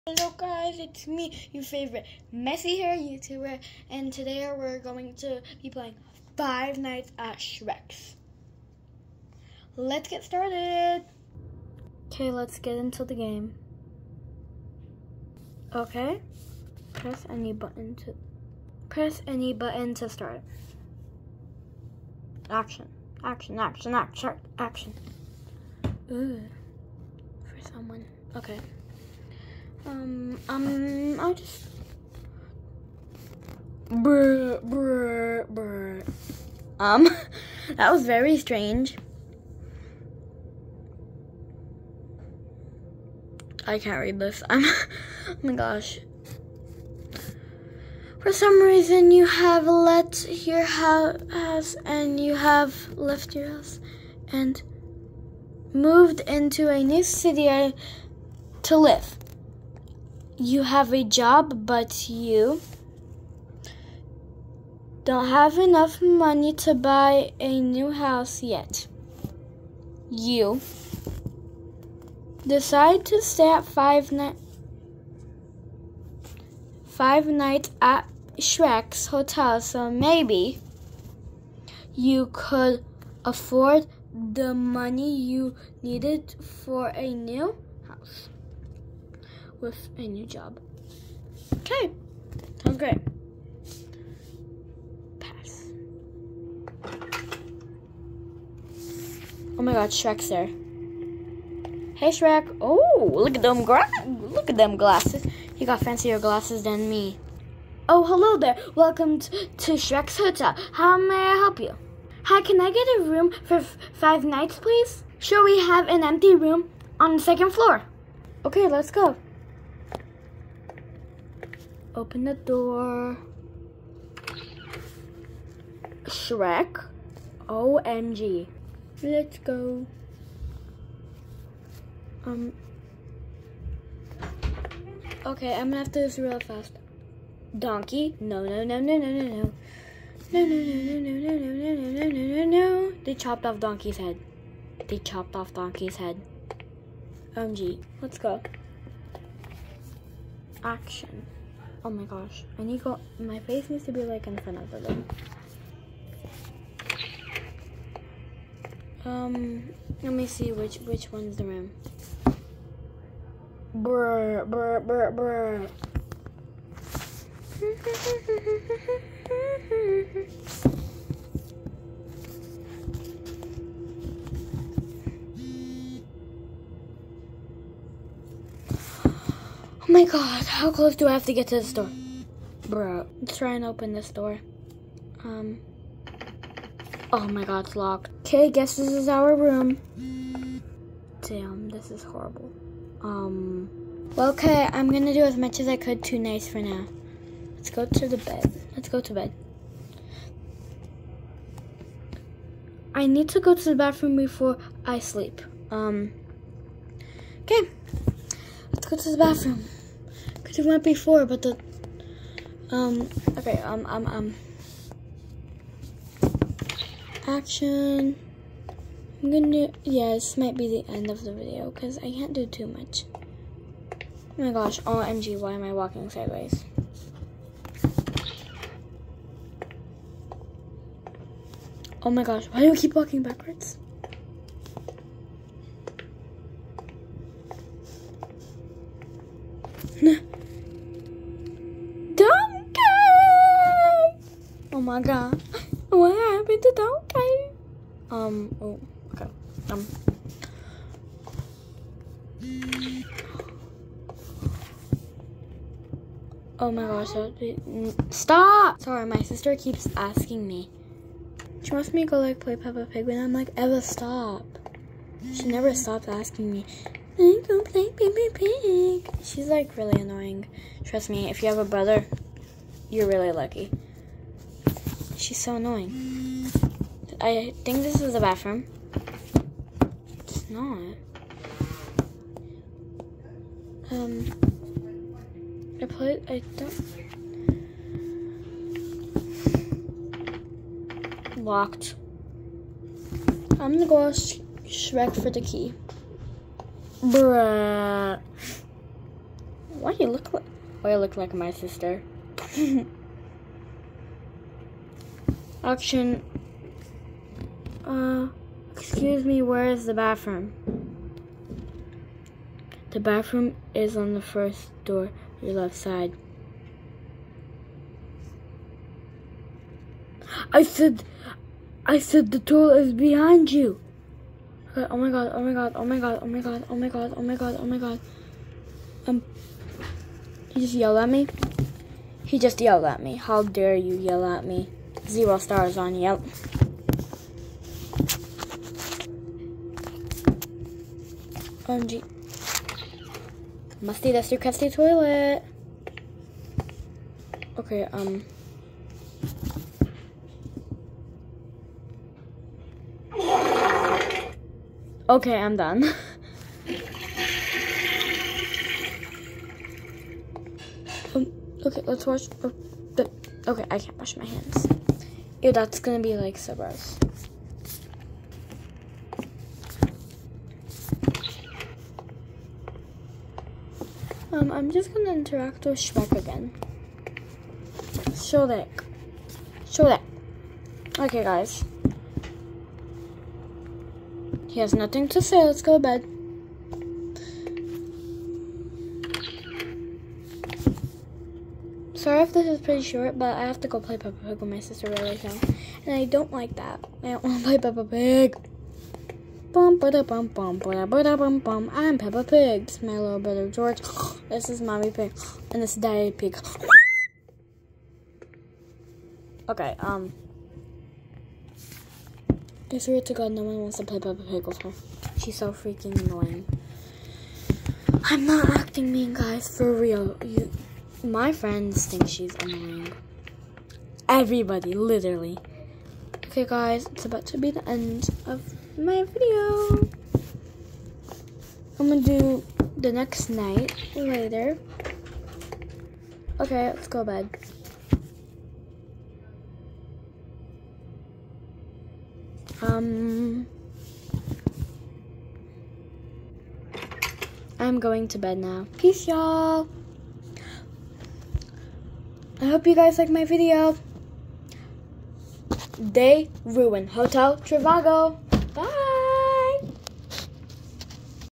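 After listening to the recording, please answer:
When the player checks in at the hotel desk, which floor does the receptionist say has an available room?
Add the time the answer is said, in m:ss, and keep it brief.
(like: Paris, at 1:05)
second floor, at 1:57.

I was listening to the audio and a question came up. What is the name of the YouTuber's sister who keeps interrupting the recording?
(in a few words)
Eva.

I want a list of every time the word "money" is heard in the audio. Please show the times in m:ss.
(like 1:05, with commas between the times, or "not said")
1:06, 1:24.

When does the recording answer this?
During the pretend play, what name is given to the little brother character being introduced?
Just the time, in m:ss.
6:43.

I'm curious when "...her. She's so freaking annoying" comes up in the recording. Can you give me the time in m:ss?
6:54.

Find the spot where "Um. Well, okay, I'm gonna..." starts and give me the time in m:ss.
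3:13.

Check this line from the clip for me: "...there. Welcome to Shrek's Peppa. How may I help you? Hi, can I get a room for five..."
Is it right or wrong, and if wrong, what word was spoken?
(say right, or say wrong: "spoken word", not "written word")
wrong: "Hotel", not "Peppa".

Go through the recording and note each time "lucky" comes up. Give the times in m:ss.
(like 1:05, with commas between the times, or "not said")
4:33.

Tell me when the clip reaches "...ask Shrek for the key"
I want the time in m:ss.
4:54.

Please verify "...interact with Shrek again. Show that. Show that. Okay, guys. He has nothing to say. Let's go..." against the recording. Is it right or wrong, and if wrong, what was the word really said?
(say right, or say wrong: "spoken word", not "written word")
right.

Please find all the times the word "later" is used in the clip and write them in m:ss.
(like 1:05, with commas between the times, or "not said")
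7:13.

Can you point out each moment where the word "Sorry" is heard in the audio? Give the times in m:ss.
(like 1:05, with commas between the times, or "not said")
4:18, 6:32.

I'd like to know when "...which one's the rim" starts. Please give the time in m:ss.
2:40.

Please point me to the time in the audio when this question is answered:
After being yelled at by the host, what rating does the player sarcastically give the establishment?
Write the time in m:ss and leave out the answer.
5:35.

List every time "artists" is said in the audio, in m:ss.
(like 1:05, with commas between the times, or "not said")
not said.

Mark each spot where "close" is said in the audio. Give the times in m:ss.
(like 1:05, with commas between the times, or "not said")
3:00.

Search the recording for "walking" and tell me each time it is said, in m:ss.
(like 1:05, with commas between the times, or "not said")
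3:45, 3:52.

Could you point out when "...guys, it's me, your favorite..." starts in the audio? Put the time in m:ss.
0:00.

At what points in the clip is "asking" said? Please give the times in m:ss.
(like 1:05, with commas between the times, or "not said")
4:19, 4:26.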